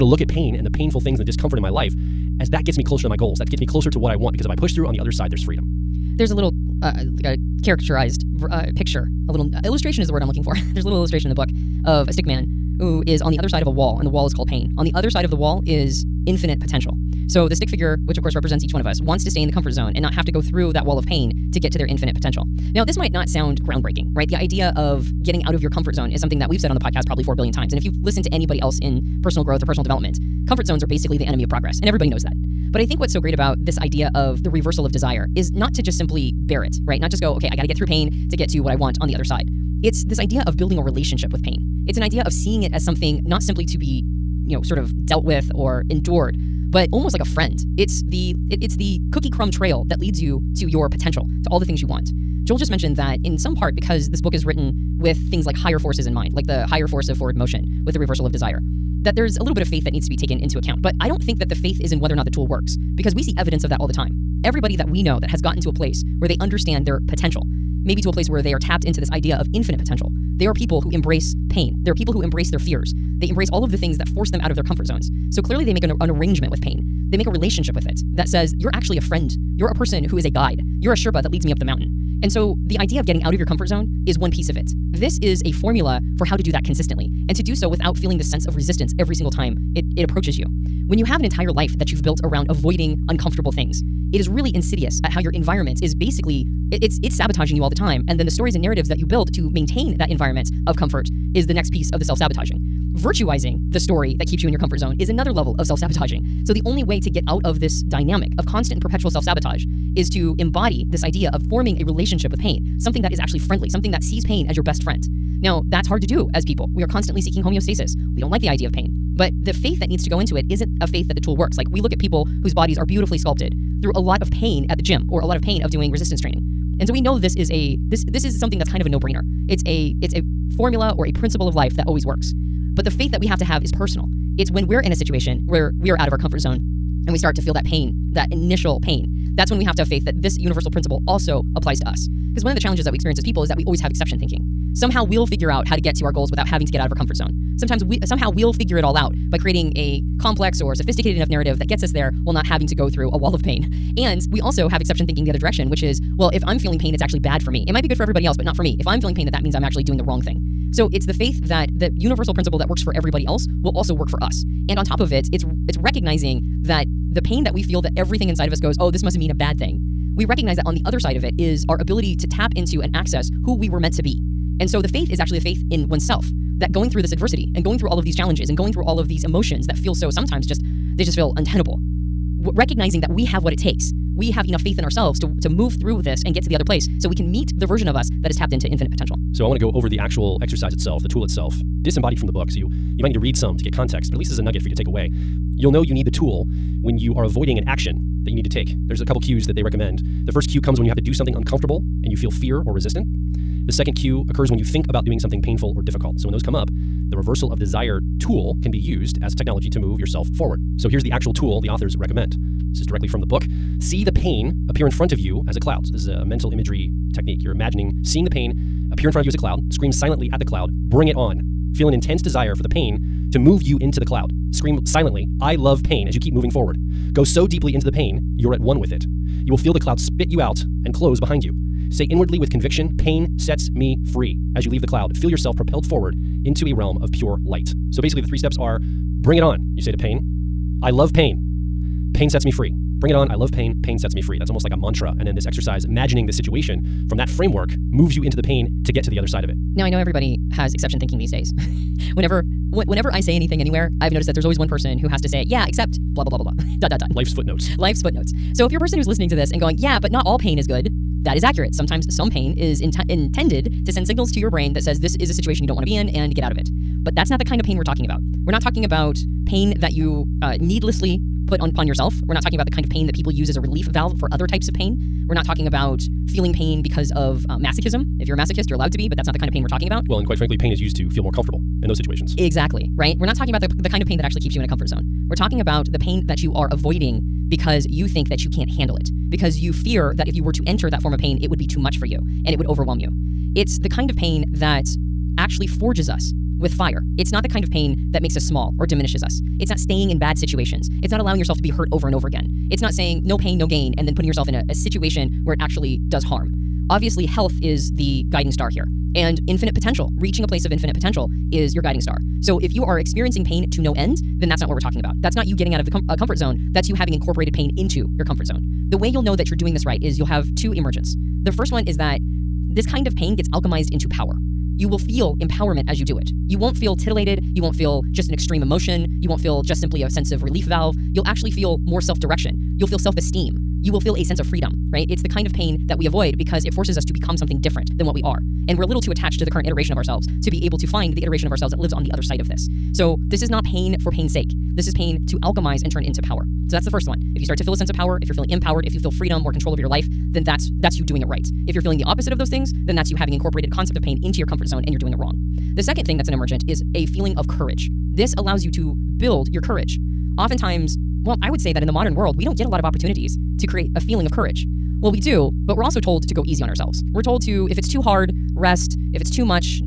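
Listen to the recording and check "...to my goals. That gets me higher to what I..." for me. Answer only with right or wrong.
wrong.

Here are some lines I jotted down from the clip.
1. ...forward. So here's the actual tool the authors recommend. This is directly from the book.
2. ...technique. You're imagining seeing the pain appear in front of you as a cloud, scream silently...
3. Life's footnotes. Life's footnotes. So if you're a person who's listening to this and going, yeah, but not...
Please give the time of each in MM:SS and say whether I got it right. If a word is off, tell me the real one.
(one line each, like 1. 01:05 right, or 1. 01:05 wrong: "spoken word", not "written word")
1. 03:30 right
2. 03:37 right
3. 04:17 right.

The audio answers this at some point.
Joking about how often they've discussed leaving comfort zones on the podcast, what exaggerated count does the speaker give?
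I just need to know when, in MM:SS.
00:27.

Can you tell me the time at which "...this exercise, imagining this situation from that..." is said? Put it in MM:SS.
04:05.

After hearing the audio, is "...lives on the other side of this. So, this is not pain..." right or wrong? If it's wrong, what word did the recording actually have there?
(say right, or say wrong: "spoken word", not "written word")
right.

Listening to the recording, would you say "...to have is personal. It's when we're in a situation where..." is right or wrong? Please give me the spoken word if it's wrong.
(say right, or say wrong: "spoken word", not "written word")
right.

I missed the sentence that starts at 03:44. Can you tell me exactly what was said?
Scream silently I love pain as you keep moving forward.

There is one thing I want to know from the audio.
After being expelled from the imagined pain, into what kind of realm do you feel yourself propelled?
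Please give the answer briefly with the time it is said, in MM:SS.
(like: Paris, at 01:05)
Pure light, at 03:57.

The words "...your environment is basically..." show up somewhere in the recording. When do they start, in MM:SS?
01:35.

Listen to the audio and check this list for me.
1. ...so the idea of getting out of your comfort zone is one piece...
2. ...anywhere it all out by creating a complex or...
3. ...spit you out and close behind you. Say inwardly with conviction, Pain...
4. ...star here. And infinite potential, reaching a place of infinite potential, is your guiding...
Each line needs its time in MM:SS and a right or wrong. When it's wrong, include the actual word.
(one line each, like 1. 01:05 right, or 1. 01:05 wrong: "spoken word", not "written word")
1. 01:22 right
2. 02:28 wrong: "figure", not "anywhere"
3. 03:49 right
4. 05:08 right.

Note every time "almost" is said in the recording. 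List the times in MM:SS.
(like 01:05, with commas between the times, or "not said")
00:46, 04:04.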